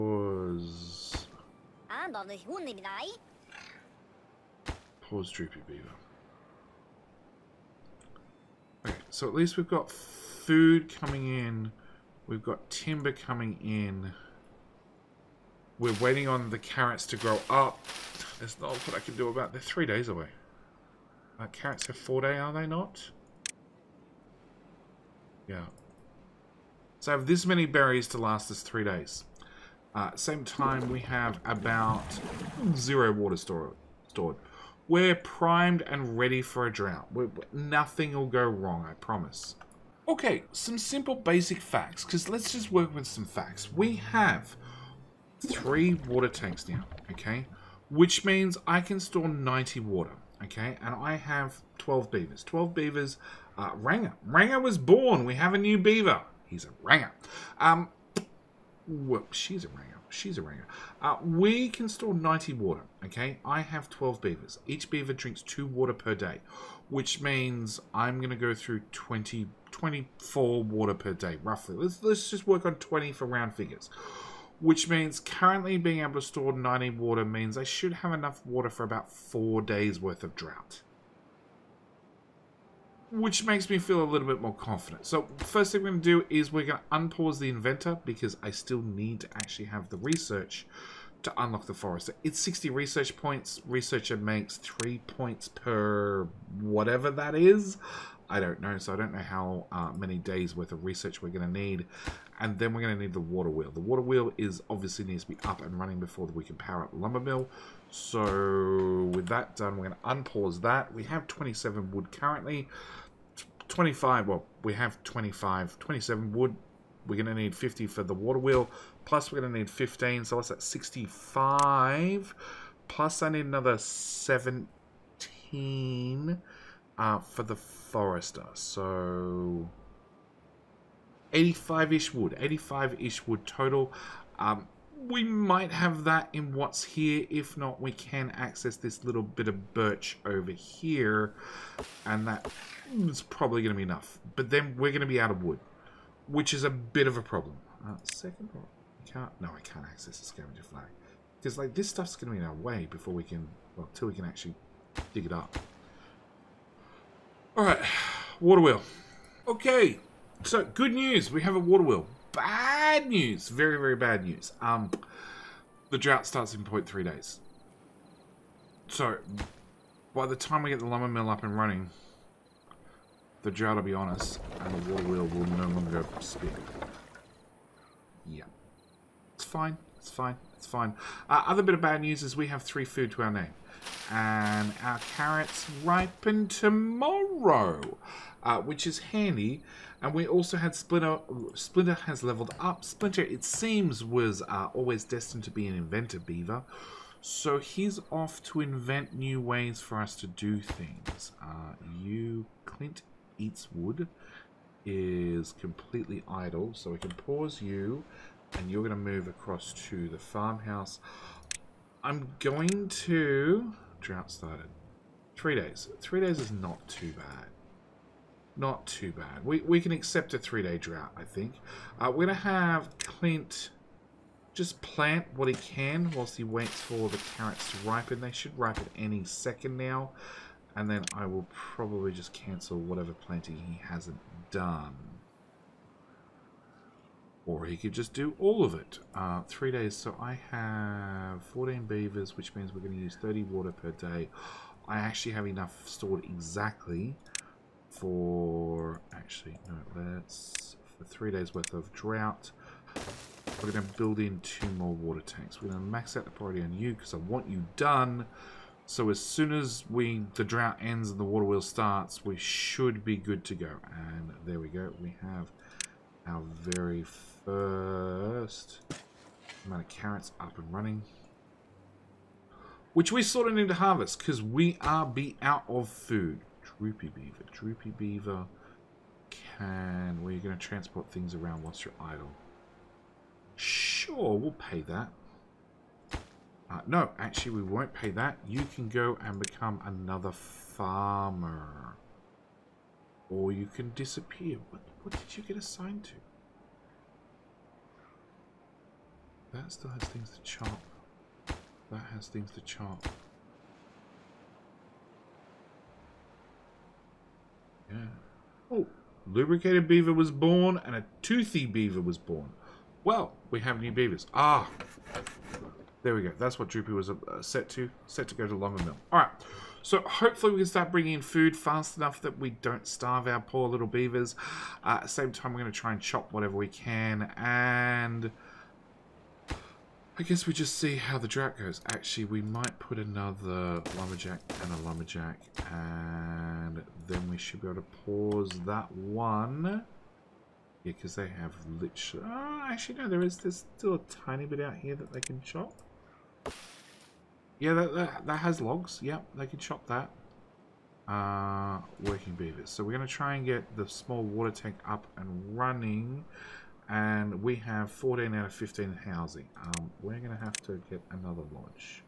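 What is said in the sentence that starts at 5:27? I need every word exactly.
And I guess we just see how the draft goes.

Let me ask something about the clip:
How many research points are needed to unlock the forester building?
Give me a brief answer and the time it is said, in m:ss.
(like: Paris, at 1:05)
60, at 1:32.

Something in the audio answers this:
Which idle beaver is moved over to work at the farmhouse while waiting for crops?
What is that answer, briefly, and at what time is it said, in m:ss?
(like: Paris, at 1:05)
Clint Eats Wood, at 3:22.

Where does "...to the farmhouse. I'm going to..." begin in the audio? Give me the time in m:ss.
3:29.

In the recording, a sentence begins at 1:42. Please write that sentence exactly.
And then we're going to need the water wheel.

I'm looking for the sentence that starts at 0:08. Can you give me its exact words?
Okay, so at least we've got food coming in.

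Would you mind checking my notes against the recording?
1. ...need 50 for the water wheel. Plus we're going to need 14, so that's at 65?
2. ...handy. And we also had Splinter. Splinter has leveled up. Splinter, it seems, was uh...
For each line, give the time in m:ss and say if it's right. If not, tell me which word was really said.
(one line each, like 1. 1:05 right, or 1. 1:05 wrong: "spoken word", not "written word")
1. 1:57 wrong: "15", not "14"
2. 3:08 right.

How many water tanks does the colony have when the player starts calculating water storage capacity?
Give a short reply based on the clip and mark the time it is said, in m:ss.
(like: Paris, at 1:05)
3, at 0:45.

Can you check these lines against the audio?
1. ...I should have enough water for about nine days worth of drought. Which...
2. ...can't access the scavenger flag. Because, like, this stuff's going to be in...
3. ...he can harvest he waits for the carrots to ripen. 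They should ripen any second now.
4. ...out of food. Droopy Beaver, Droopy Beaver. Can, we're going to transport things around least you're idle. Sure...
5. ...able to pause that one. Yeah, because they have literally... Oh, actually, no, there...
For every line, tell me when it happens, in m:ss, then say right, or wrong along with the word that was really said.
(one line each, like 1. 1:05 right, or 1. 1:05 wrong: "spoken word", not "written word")
1. 1:17 wrong: "four", not "nine"
2. 2:29 right
3. 3:45 wrong: "whilst", not "harvest"
4. 4:35 wrong: "whilst", not "least"
5. 5:37 right.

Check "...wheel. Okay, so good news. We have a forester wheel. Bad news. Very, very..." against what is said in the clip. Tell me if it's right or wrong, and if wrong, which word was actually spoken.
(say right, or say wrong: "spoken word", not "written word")
wrong: "water", not "forester".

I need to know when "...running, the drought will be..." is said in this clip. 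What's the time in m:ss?
2:51.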